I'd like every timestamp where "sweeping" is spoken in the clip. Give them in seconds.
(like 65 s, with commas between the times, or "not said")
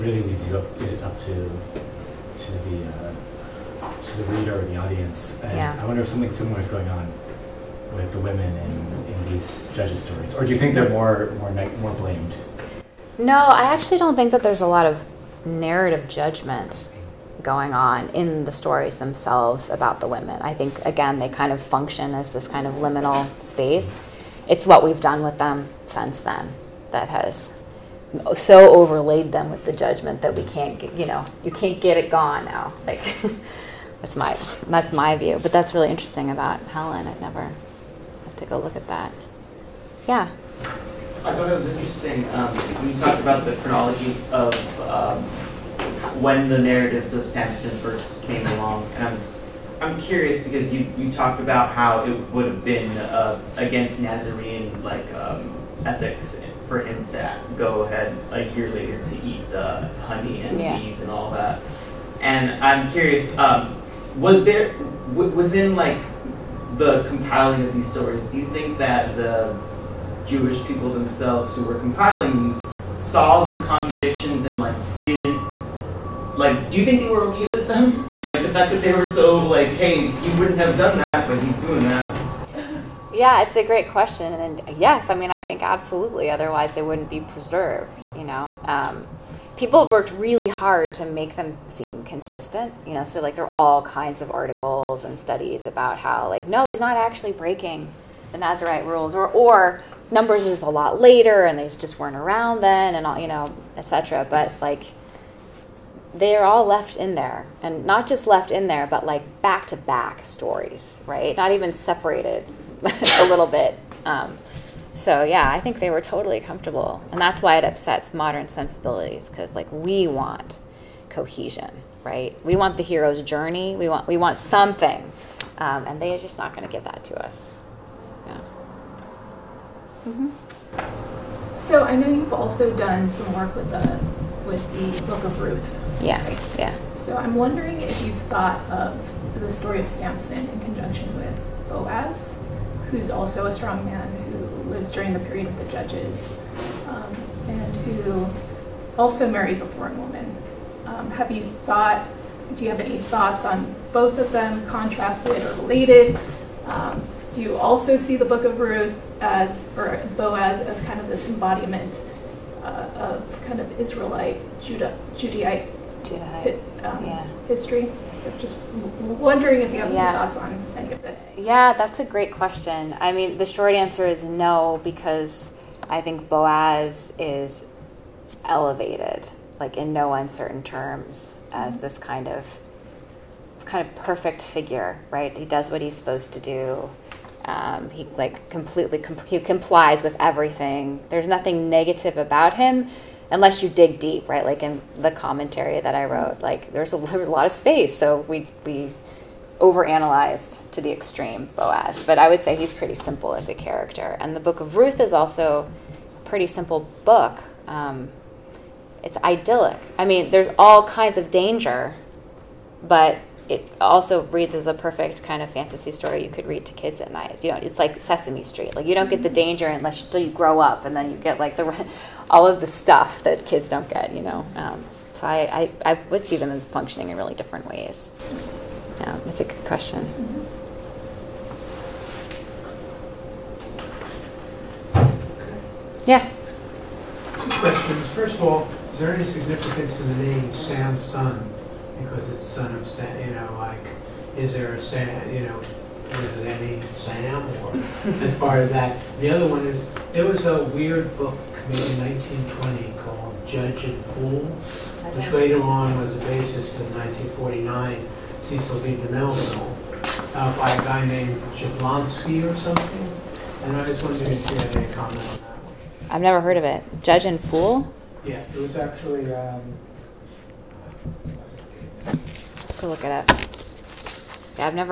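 not said.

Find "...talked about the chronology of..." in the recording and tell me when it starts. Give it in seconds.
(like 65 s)
42 s.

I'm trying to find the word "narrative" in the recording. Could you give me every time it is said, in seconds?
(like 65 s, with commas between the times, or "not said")
15 s, 46 s.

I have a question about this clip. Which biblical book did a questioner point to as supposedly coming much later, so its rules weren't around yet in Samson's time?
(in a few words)
Numbers.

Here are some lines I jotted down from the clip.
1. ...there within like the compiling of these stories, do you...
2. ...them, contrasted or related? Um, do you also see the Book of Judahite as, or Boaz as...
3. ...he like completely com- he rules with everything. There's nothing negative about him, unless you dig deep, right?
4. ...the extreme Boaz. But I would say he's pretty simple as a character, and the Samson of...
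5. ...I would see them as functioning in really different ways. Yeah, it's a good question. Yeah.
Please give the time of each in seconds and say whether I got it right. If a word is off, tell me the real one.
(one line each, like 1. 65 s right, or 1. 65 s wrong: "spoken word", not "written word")
1. 64 s right
2. 154 s wrong: "Ruth", not "Judahite"
3. 187 s wrong: "complies", not "rules"
4. 200 s wrong: "Book", not "Samson"
5. 225 s right.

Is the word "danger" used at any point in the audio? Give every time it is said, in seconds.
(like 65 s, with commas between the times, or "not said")
211 s, 219 s.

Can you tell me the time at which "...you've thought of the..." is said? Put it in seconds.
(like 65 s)
138 s.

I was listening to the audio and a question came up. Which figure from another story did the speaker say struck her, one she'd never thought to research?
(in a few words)
Helen.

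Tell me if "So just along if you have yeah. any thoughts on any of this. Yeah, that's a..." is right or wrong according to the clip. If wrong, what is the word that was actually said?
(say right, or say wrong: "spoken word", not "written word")
wrong: "wondering", not "along".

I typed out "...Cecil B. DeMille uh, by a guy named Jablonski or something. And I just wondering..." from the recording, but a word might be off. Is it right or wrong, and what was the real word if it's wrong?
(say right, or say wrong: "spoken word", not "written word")
right.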